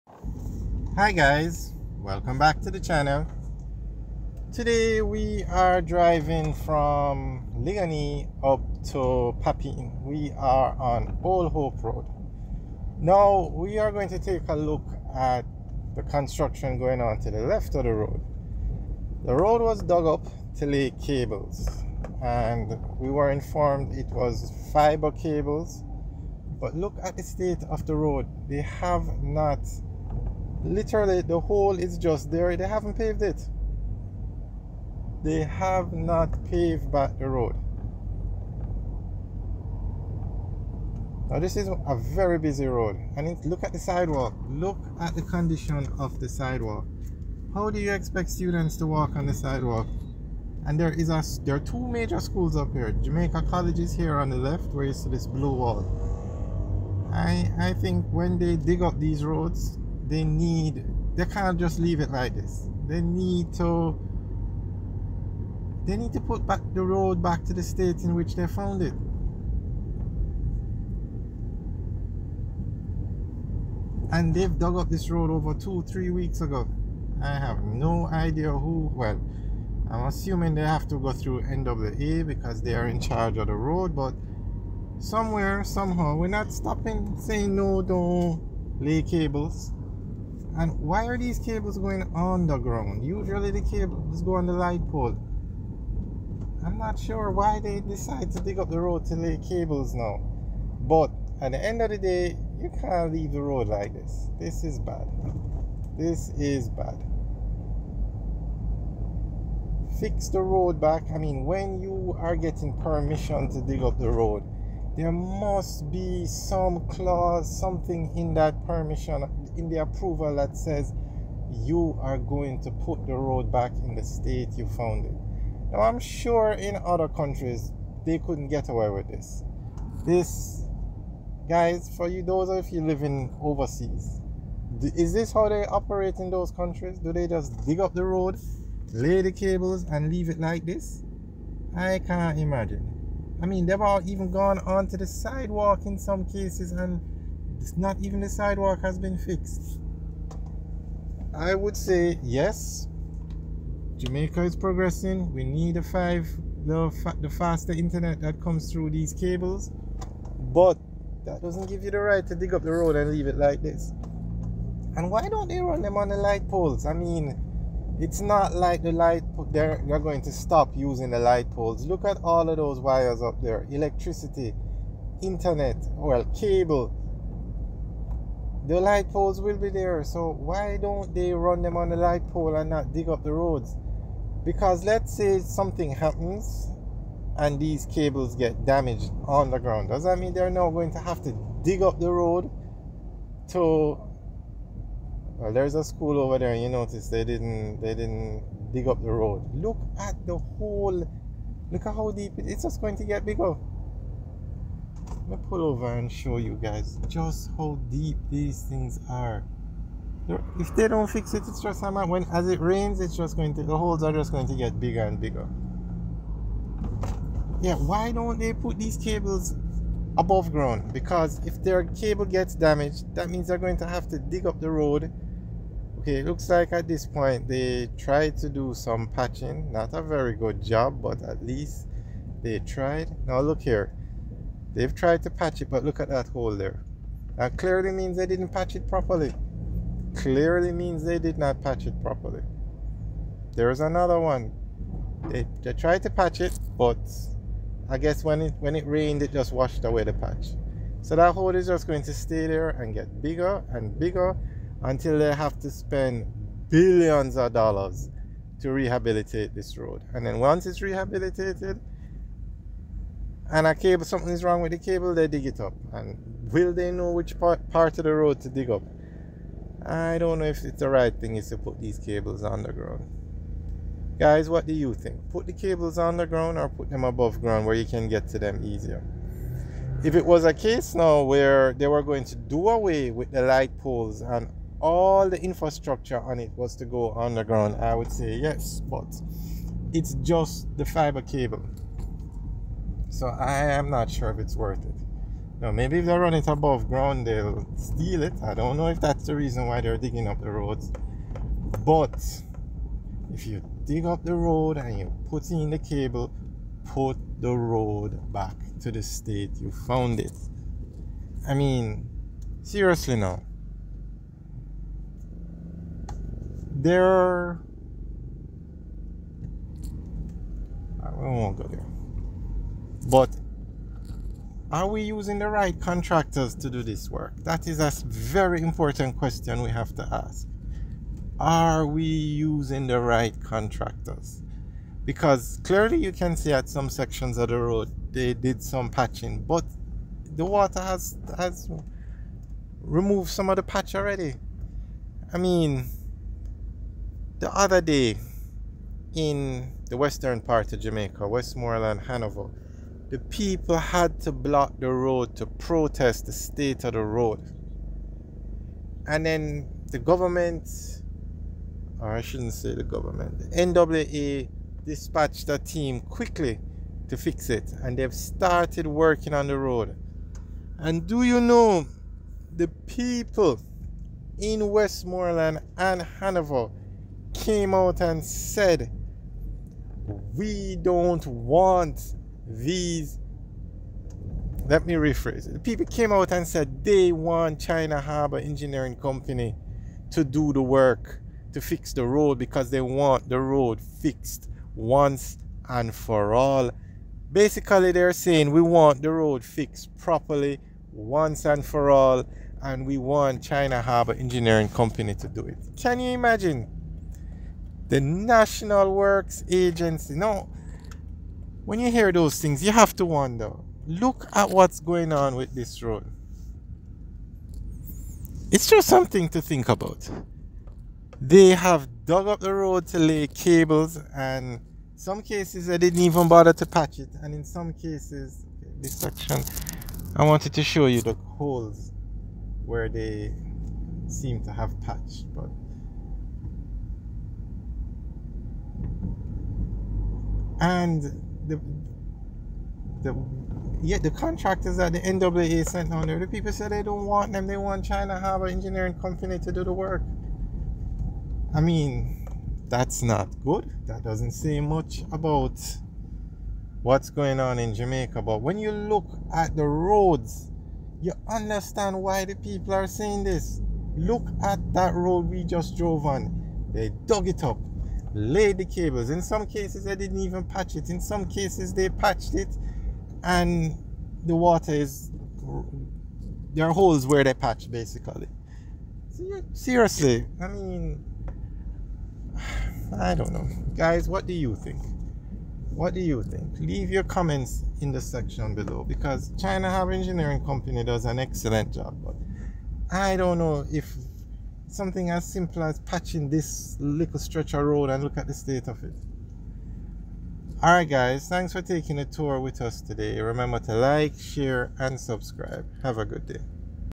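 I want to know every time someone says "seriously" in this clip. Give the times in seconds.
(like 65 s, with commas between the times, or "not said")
312 s, 479 s.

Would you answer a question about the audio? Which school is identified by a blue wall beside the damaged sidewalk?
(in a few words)
Jamaica College.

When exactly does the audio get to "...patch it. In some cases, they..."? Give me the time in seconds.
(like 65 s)
470 s.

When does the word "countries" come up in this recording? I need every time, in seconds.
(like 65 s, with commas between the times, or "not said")
127 s, 136 s.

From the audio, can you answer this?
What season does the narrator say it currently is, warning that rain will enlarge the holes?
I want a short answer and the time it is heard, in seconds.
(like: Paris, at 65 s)
Summer, at 211 s.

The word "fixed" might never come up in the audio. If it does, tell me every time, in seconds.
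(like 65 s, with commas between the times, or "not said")
149 s, 393 s, 399 s.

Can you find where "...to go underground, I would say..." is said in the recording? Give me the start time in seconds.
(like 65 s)
286 s.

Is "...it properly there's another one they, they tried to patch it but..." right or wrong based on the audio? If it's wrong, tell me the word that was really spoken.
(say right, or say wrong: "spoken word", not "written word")
right.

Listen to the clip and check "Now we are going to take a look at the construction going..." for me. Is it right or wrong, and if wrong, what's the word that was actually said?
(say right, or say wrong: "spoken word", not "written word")
right.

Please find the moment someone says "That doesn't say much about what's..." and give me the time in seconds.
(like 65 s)
453 s.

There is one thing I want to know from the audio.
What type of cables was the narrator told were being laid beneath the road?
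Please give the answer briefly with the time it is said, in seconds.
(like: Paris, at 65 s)
Fiber cables, at 24 s.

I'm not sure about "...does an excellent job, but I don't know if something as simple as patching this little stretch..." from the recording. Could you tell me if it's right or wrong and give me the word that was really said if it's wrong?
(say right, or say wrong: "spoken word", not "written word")
right.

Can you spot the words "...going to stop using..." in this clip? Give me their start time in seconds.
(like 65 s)
169 s.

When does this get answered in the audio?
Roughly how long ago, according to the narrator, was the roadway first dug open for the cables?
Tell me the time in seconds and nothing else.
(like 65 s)
75 s.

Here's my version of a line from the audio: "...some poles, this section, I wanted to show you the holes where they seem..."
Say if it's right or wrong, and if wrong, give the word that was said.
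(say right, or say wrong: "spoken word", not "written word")
wrong: "cases", not "poles".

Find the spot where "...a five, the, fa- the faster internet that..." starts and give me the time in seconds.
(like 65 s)
155 s.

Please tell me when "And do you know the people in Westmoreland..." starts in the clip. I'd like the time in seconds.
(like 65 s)
370 s.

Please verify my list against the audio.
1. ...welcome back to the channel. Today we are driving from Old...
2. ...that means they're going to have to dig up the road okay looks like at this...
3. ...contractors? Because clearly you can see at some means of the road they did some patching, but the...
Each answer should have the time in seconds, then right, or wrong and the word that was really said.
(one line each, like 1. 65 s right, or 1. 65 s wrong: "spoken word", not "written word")
1. 1 s wrong: "Liguanea", not "Old"
2. 223 s right
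3. 333 s wrong: "sections", not "means".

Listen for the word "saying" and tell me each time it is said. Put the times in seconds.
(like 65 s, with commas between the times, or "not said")
87 s, 398 s, 462 s.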